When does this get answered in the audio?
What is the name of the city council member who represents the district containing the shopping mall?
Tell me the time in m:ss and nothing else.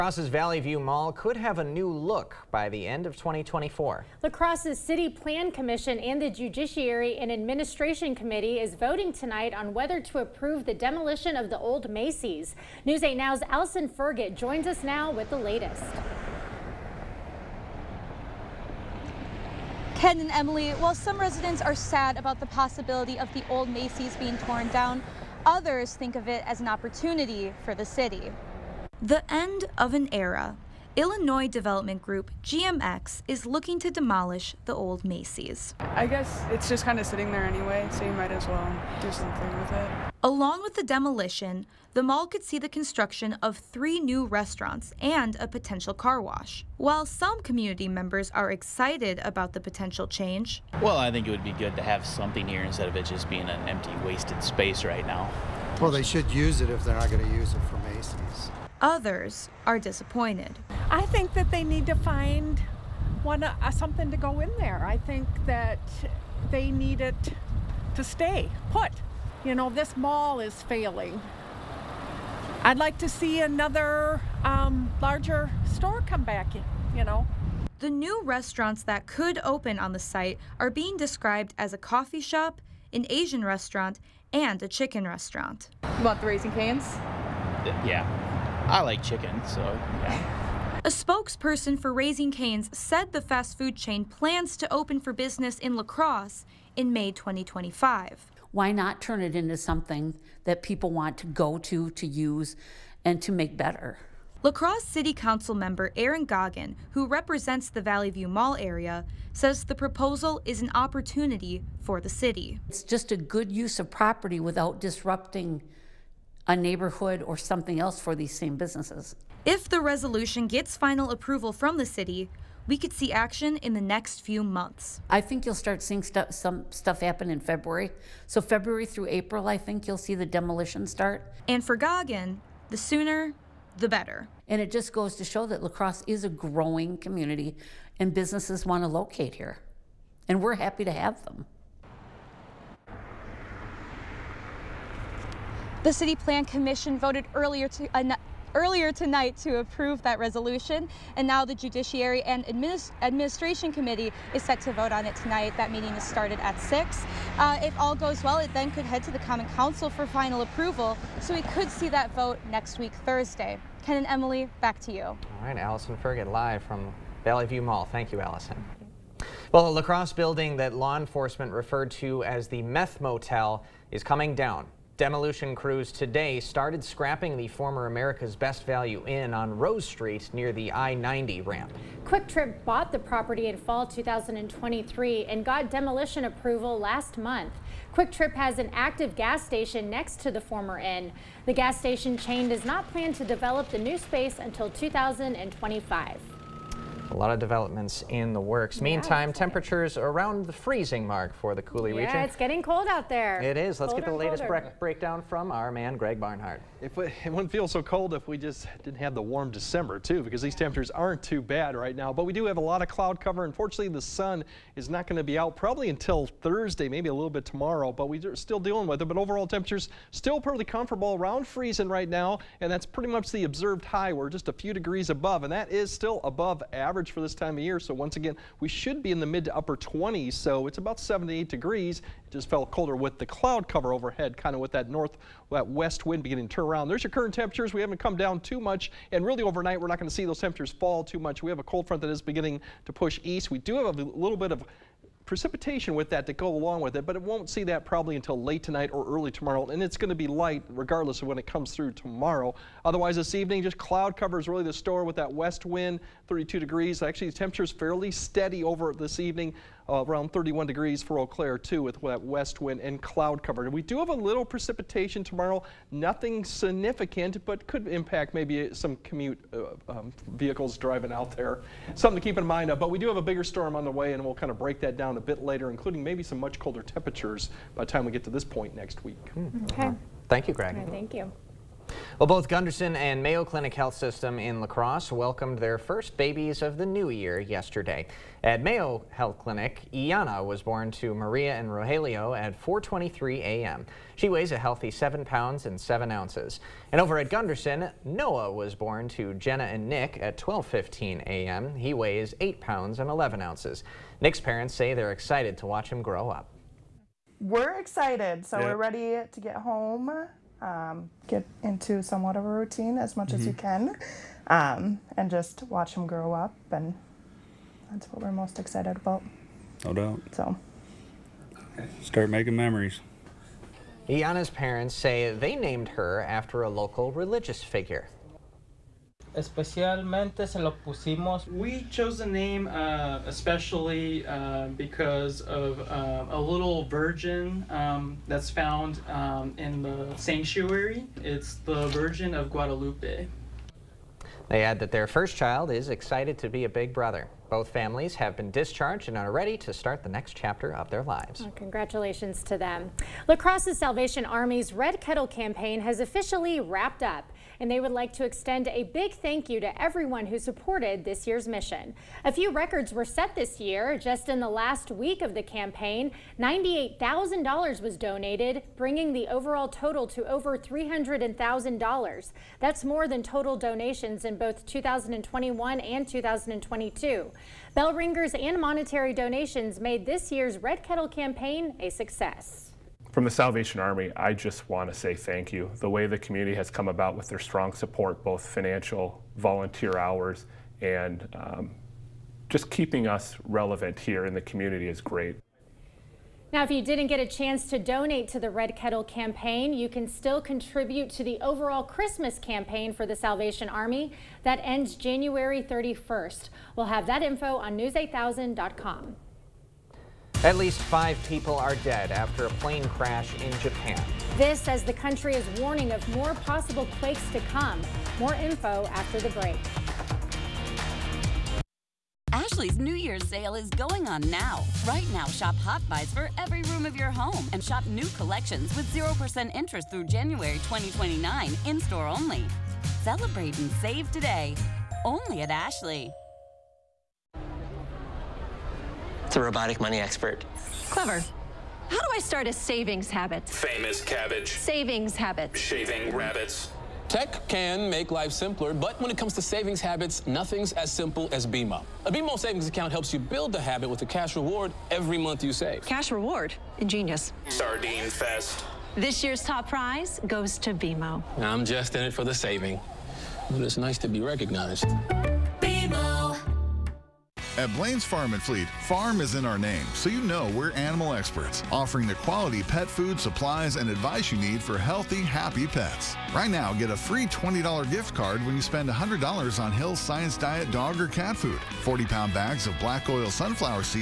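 1:45.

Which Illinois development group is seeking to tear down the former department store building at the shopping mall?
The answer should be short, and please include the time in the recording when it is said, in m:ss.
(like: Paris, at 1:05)
GMX, at 0:32.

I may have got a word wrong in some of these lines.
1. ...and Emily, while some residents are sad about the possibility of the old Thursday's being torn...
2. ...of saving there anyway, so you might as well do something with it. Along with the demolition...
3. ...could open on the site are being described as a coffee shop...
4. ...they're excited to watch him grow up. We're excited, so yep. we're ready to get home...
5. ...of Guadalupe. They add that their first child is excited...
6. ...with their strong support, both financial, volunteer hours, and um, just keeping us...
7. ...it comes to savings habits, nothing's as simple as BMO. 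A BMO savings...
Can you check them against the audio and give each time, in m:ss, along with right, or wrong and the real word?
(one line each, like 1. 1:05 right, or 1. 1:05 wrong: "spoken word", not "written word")
1. 0:20 wrong: "Macy", not "Thursday"
2. 0:36 wrong: "sitting", not "saving"
3. 1:19 right
4. 5:04 right
5. 5:42 right
6. 6:27 right
7. 7:29 right.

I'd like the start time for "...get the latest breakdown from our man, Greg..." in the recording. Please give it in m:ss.
3:24.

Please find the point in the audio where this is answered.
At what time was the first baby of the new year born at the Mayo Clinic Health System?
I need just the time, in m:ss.
4:52.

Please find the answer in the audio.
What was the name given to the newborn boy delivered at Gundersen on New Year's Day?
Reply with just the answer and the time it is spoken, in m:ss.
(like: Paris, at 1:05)
Noah, at 4:58.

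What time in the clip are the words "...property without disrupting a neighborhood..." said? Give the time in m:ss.
1:53.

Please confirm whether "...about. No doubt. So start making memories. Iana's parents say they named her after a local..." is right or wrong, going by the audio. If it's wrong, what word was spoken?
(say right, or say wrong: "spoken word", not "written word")
right.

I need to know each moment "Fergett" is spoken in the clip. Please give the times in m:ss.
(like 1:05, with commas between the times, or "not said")
0:13, 2:45.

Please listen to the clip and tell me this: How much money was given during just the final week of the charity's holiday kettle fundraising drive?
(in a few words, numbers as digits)
$98,000.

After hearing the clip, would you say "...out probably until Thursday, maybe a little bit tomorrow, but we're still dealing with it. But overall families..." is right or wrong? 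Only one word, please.
wrong.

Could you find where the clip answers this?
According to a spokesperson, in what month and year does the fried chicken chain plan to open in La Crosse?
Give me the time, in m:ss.
1:36.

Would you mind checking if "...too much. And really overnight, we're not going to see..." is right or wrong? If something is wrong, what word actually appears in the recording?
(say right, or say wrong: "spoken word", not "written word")
right.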